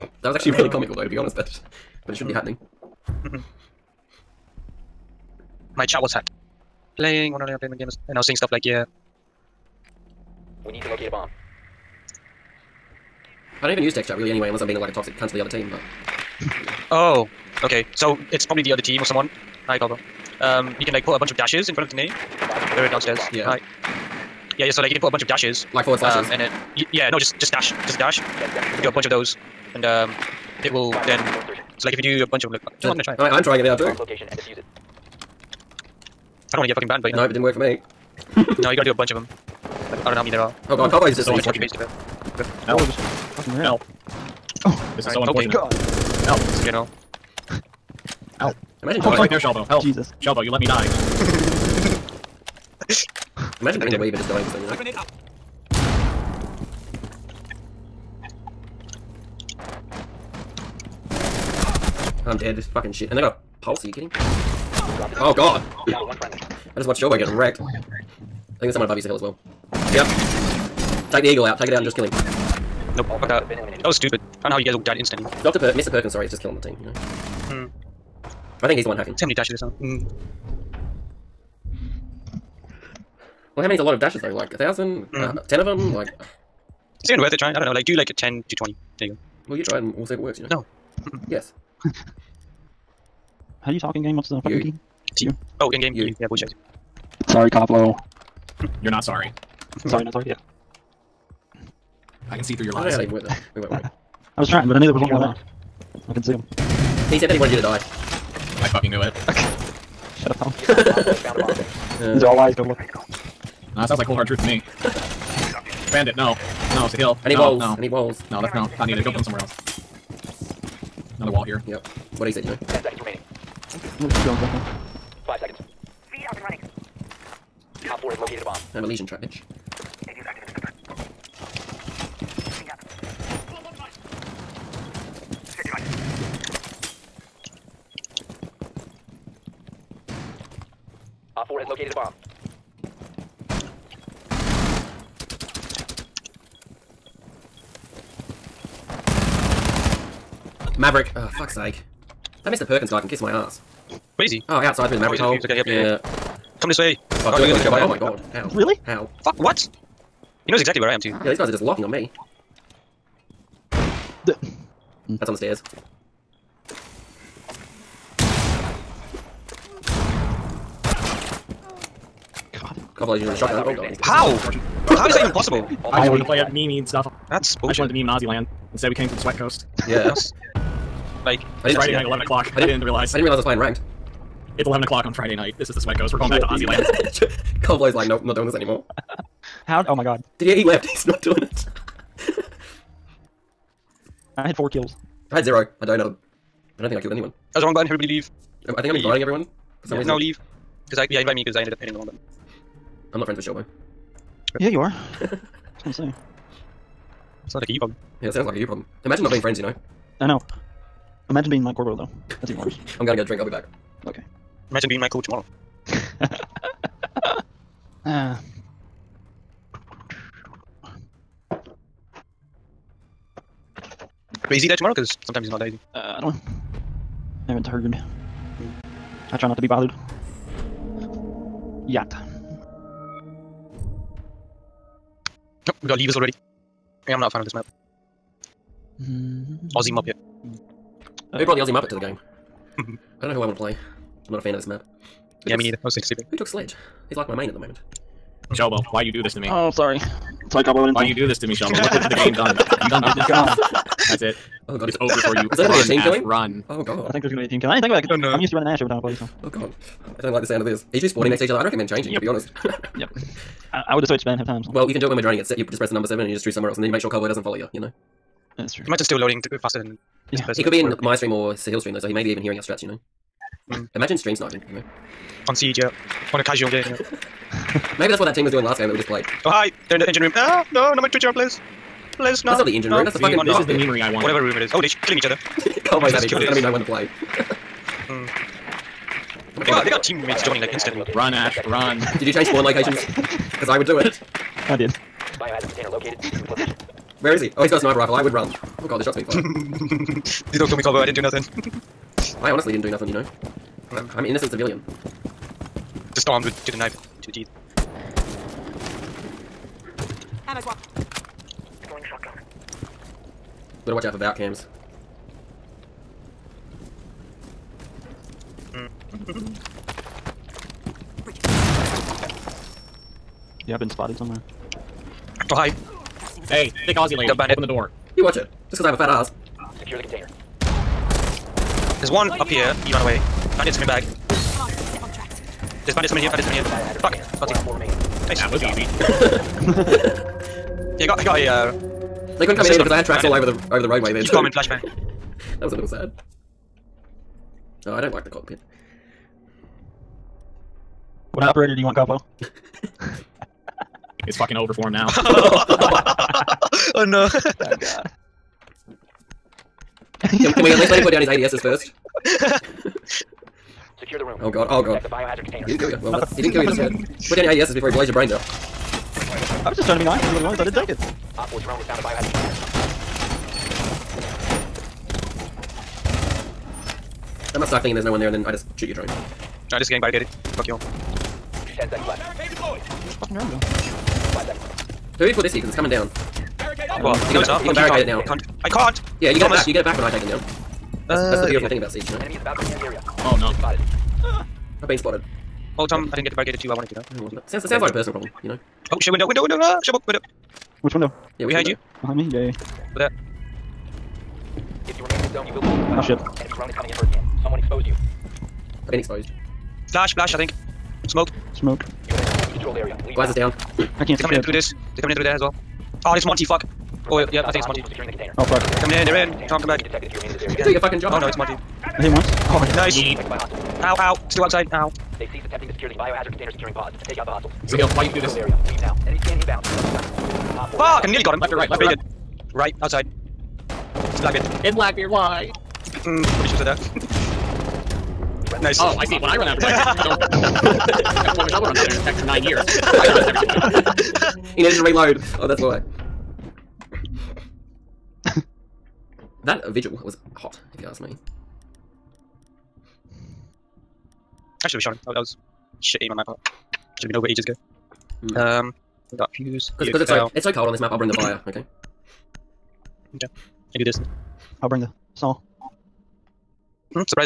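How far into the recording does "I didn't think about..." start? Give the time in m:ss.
4:17.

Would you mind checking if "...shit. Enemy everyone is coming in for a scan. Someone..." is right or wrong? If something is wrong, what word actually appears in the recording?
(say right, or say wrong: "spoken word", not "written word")
wrong: "drone", not "everyone".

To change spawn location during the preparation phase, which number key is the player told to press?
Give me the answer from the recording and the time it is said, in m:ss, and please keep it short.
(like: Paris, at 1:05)
7, at 4:26.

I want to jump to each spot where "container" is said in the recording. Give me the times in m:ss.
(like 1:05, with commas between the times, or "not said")
4:55, 5:30, 6:05, 6:12, 7:06.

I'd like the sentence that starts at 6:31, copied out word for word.
That's, uh, that's the uh, beautiful thing about Siege, you know?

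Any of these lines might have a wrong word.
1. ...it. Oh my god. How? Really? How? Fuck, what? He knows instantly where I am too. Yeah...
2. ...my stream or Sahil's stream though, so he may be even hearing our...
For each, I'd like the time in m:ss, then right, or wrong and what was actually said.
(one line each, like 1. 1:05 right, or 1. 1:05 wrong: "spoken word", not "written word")
1. 2:37 wrong: "exactly", not "instantly"
2. 4:31 right.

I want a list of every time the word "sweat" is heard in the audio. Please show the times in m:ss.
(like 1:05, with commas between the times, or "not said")
2:59, 3:05.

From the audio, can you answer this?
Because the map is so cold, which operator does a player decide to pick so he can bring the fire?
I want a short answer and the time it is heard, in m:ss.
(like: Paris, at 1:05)
Fuze, at 7:39.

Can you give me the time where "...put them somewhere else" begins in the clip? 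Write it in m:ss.
1:59.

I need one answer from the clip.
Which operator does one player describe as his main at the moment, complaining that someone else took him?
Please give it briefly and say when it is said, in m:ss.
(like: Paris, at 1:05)
Sledge, at 4:06.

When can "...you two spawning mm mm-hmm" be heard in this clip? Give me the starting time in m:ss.
4:20.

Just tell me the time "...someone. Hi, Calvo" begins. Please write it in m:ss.
0:19.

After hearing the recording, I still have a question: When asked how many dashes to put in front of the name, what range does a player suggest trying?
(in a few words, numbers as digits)
10 to 20.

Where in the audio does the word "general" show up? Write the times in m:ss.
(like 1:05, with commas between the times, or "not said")
0:46.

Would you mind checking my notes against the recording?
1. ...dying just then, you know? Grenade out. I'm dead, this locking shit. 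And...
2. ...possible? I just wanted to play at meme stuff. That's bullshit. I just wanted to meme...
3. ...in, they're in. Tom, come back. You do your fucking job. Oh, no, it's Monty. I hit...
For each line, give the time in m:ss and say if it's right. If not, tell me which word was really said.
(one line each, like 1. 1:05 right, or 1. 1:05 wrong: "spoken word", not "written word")
1. 0:54 wrong: "fucking", not "locking"
2. 2:55 right
3. 6:58 right.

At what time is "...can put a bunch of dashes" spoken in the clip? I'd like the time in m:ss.
0:24.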